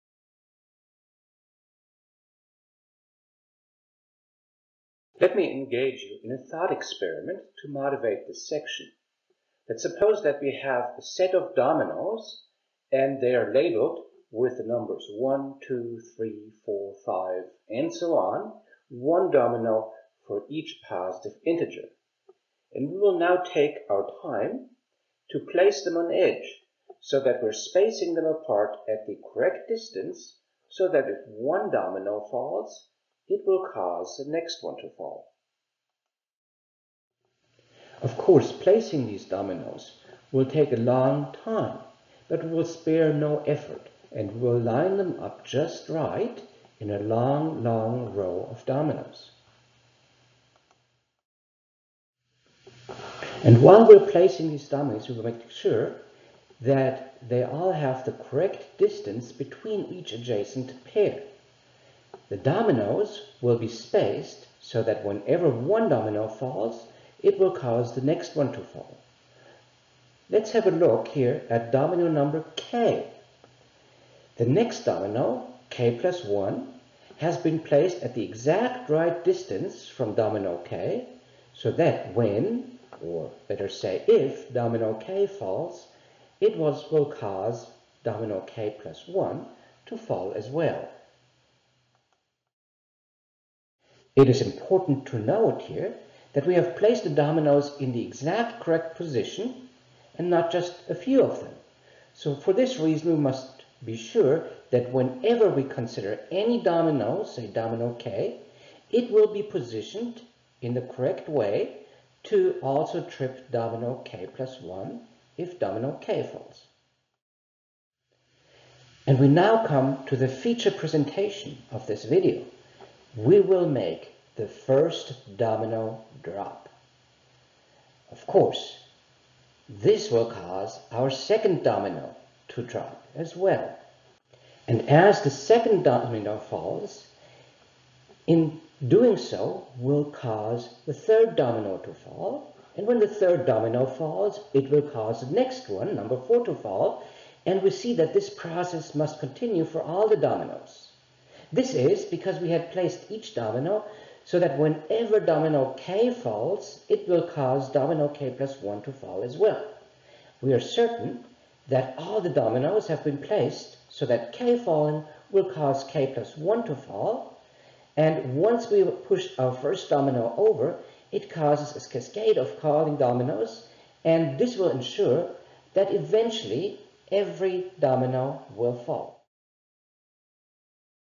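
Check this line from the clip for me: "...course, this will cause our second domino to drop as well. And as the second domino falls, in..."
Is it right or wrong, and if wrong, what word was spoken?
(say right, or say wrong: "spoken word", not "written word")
right.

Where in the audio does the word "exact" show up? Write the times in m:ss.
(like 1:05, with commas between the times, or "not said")
1:18, 1:38.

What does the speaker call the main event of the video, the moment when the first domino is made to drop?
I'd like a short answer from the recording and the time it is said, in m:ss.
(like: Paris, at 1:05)
Feature presentation, at 2:00.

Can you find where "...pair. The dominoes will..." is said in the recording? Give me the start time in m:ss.
1:00.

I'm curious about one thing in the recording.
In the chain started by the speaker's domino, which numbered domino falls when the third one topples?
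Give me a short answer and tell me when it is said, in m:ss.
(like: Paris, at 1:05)
4, at 2:25.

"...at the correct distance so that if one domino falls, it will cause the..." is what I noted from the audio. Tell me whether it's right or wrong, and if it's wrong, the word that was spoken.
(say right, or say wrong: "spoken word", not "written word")
right.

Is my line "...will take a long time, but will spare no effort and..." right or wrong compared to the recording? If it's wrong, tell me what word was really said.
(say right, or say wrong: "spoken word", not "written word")
right.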